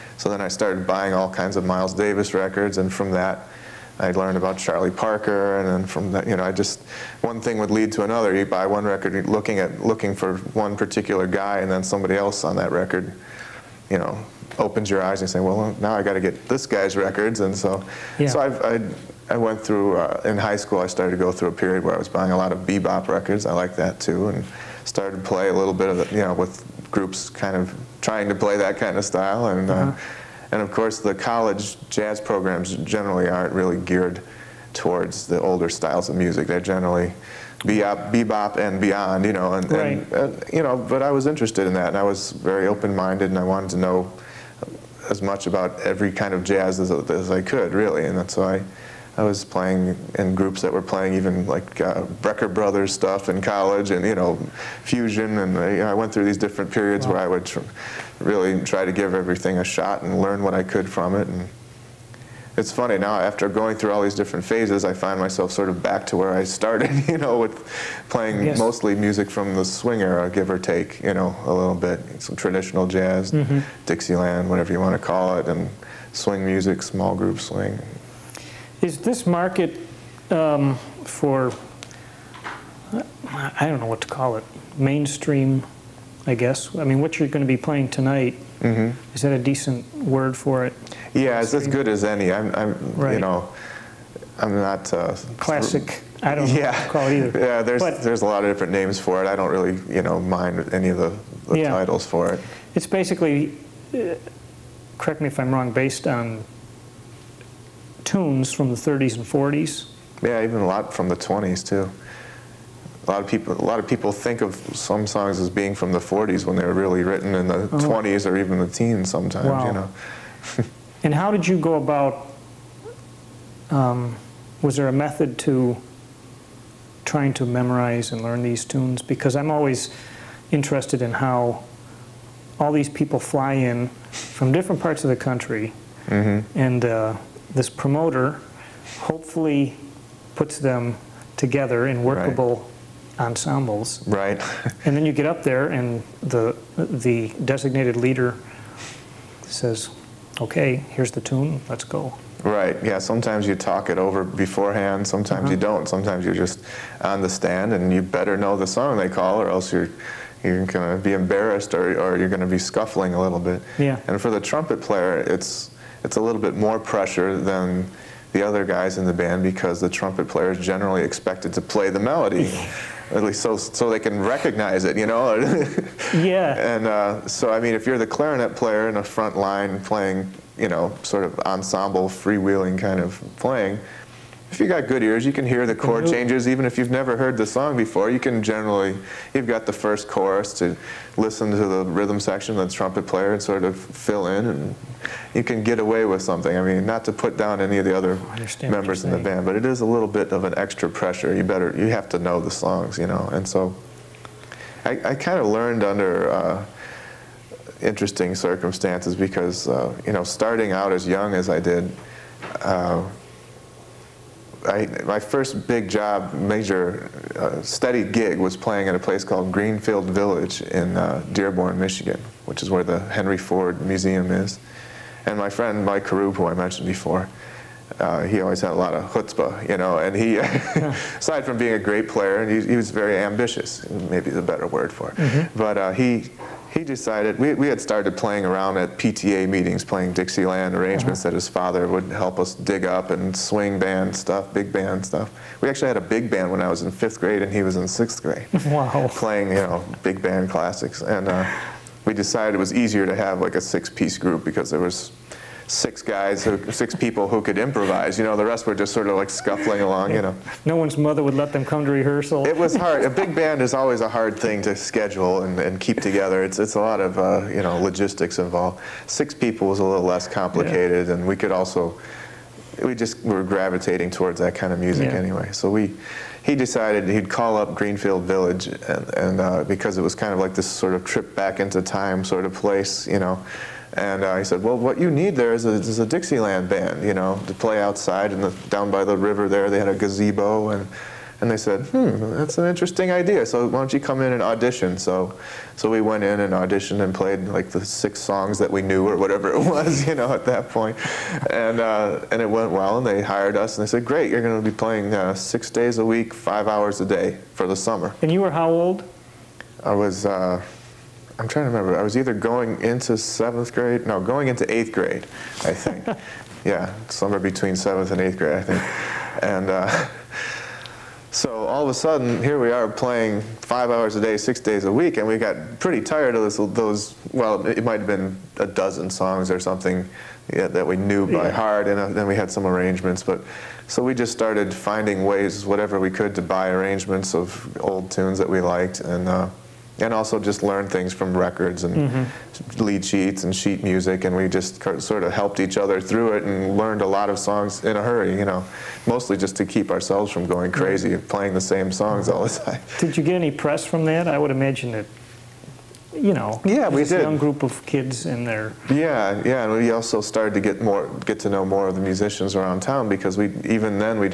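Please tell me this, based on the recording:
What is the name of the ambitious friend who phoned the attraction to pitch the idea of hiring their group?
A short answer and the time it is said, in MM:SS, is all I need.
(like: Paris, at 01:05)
Mike Karoub, at 03:45.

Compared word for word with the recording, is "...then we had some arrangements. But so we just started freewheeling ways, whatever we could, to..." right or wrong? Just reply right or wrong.
wrong.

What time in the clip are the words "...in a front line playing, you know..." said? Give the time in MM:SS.
02:58.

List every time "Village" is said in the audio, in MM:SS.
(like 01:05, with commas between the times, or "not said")
03:40, 04:38.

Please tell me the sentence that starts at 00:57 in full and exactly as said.
where I would tr really try to give everything a shot and learn what I could from it.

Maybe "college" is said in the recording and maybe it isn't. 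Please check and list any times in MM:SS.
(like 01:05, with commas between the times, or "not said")
00:31, 00:53.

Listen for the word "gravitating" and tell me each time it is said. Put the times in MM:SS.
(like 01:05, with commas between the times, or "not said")
04:33.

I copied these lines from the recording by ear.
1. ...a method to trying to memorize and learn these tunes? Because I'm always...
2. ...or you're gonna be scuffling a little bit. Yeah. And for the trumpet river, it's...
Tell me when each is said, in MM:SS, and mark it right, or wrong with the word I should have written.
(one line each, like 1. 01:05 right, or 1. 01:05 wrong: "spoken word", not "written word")
1. 02:04 right
2. 02:41 wrong: "player", not "river".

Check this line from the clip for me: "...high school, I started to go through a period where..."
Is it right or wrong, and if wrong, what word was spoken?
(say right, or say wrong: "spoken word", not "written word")
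right.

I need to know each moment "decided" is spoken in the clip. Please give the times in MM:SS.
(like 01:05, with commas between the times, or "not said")
03:56, 04:12, 04:36.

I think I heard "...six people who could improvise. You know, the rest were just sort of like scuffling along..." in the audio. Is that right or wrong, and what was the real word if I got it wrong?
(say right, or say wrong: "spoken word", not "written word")
right.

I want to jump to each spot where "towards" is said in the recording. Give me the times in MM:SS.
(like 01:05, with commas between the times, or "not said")
00:34, 04:34.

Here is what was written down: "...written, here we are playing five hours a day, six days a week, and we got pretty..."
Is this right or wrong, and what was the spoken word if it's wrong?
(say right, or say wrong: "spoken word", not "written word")
wrong: "sudden", not "written".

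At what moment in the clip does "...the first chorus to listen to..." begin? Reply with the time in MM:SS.
03:09.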